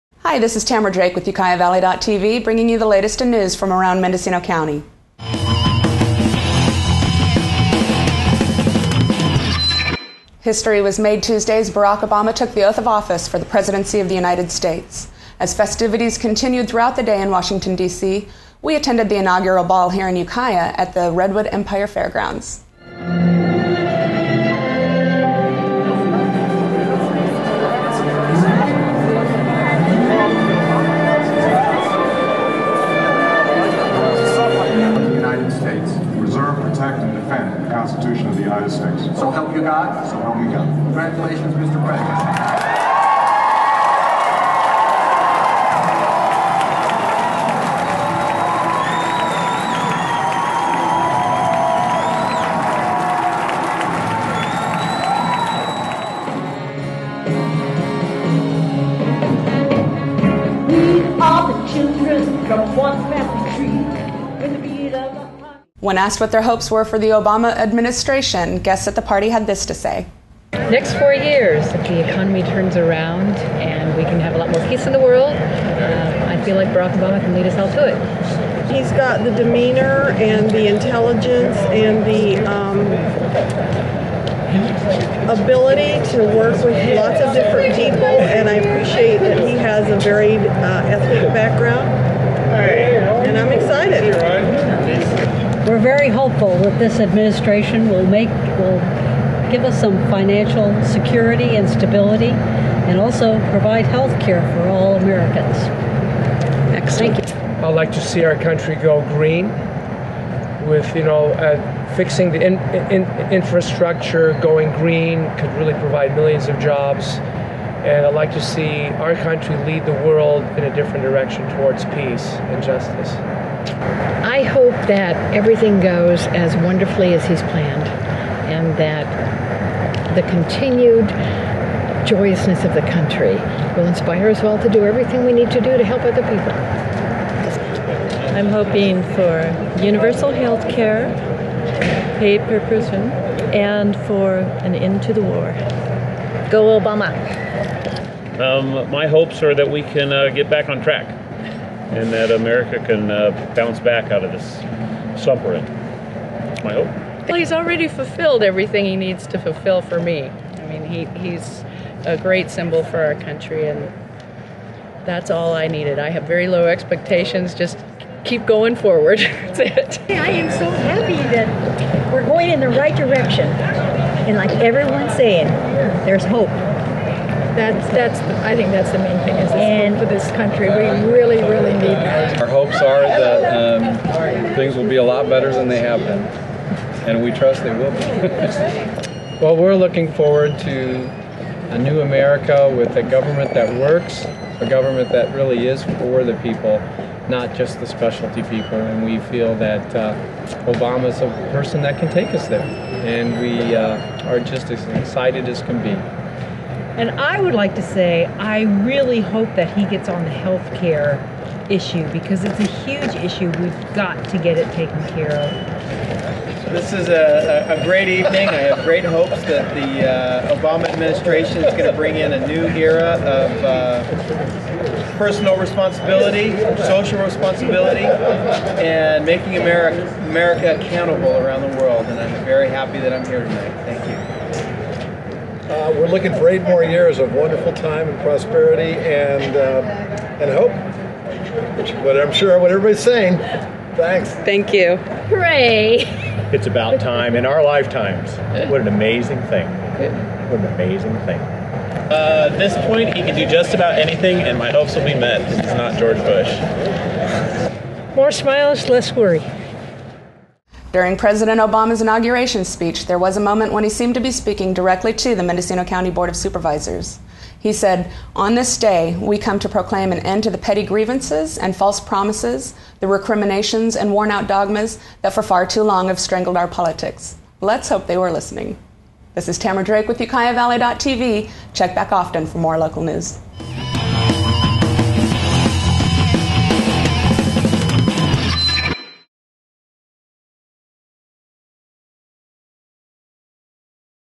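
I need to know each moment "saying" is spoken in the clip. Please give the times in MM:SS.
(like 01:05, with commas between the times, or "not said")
02:55, 04:03.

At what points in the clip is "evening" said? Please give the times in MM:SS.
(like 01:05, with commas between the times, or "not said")
03:38.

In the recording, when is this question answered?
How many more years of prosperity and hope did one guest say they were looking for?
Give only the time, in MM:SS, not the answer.
03:56.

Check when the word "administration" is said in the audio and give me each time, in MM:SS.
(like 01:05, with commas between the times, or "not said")
01:07, 01:36, 03:40.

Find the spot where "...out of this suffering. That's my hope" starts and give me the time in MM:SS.
02:34.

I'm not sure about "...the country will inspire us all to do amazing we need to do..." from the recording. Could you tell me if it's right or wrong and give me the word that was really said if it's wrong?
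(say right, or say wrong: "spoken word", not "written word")
wrong: "everything", not "amazing".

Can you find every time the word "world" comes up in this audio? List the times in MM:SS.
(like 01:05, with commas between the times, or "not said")
01:14, 02:00, 03:51.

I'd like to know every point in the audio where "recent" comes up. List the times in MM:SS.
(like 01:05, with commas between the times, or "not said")
not said.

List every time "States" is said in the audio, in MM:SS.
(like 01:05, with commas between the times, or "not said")
00:14, 00:38.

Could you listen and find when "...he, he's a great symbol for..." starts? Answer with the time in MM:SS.
02:40.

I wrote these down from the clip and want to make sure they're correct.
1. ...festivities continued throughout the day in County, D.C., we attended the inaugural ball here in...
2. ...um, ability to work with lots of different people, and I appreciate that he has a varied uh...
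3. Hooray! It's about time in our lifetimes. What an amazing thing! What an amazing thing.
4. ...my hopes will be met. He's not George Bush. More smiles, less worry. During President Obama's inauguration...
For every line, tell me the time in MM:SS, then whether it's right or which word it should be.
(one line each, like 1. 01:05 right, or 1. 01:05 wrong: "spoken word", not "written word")
1. 00:15 wrong: "Washington", not "County"
2. 01:22 right
3. 04:04 right
4. 04:14 right.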